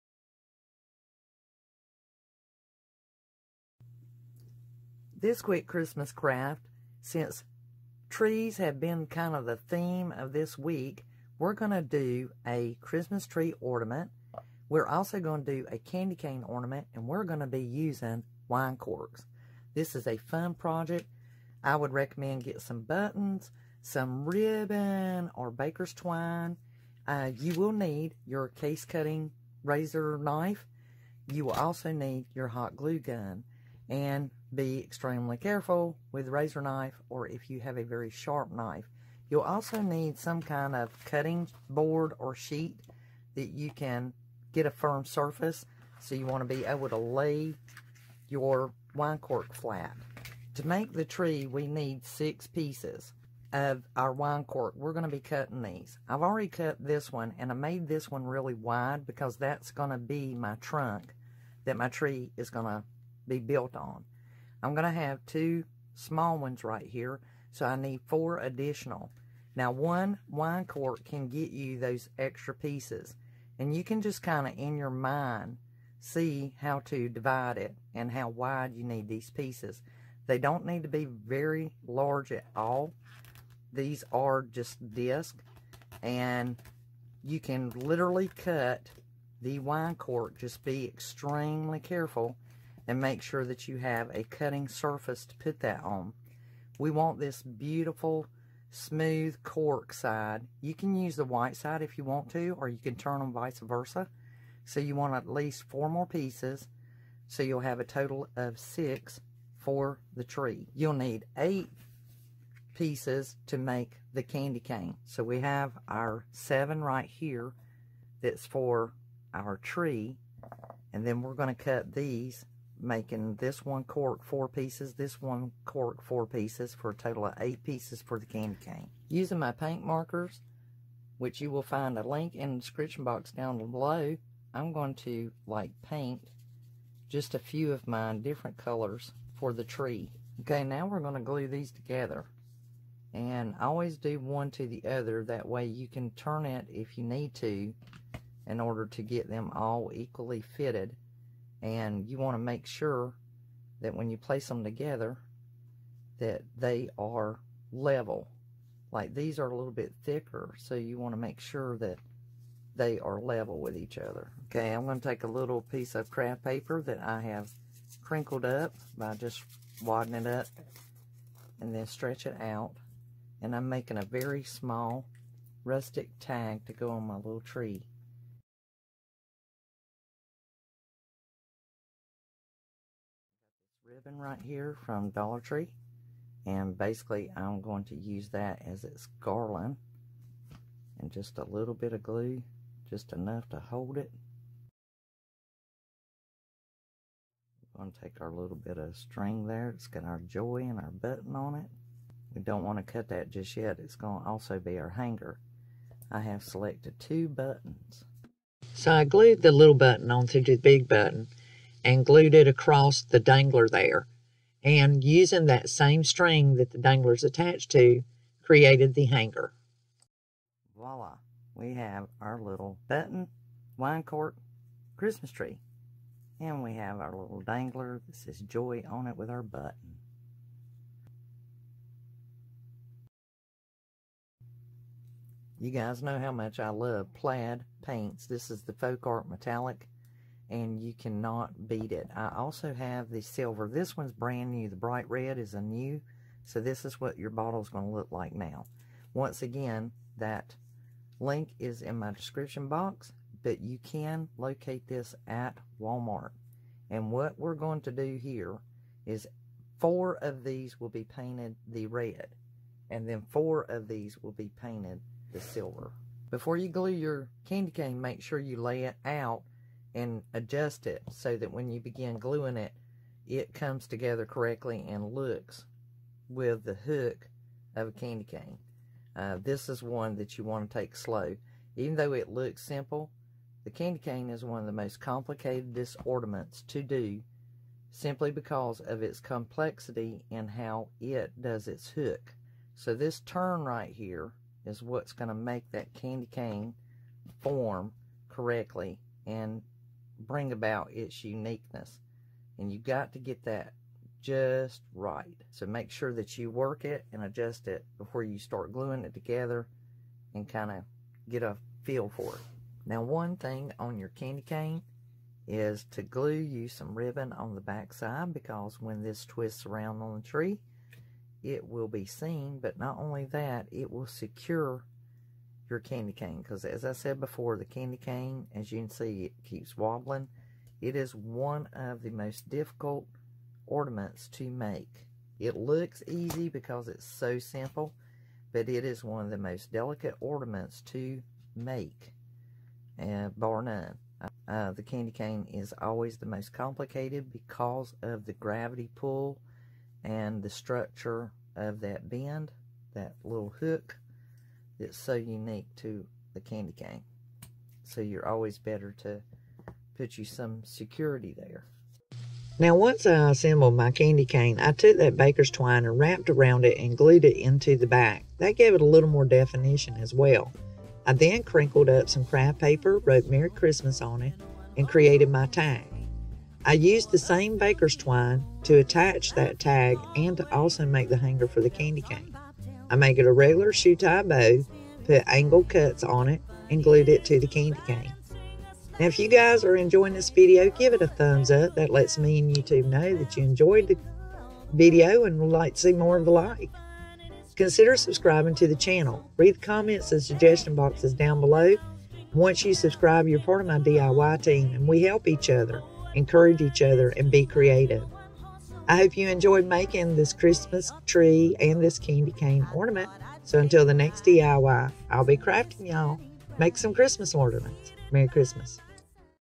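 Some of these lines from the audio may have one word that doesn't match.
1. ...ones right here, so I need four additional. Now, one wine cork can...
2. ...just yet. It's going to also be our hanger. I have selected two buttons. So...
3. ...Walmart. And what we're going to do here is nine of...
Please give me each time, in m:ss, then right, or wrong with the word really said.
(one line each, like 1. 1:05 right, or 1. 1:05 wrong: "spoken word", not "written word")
1. 1:06 right
2. 3:23 right
3. 4:15 wrong: "four", not "nine".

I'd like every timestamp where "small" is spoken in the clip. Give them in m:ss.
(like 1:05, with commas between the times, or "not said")
1:05, 2:54.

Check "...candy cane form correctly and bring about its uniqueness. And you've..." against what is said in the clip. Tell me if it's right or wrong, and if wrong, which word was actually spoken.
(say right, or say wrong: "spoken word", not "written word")
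right.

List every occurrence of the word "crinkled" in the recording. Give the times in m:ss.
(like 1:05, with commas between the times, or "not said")
2:48, 6:11.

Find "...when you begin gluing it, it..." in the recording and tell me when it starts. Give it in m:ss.
4:31.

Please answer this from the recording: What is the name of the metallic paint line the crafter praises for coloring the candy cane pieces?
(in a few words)
Folk Art Metallic.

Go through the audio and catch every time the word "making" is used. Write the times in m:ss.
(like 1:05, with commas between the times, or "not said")
2:02, 2:53, 6:49.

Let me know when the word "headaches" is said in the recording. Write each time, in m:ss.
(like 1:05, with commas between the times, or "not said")
not said.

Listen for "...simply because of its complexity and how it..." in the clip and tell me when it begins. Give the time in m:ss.
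4:47.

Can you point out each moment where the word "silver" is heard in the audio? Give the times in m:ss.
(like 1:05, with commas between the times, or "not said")
4:03, 4:25.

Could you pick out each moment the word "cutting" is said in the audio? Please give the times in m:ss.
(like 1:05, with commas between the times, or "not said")
0:28, 0:41, 0:55, 1:34.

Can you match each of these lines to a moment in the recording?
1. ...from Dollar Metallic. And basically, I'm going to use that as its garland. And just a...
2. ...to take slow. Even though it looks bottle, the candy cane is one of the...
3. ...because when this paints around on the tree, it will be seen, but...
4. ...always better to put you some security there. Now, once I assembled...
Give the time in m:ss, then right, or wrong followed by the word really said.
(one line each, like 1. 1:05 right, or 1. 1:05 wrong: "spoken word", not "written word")
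1. 3:04 wrong: "Tree", not "Metallic"
2. 4:40 wrong: "simple", not "bottle"
3. 5:18 wrong: "twists", not "paints"
4. 5:58 right.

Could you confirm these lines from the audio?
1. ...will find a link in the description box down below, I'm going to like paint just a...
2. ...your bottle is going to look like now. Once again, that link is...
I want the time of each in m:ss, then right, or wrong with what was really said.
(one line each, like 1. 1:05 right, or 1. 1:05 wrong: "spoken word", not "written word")
1. 2:11 right
2. 4:07 right.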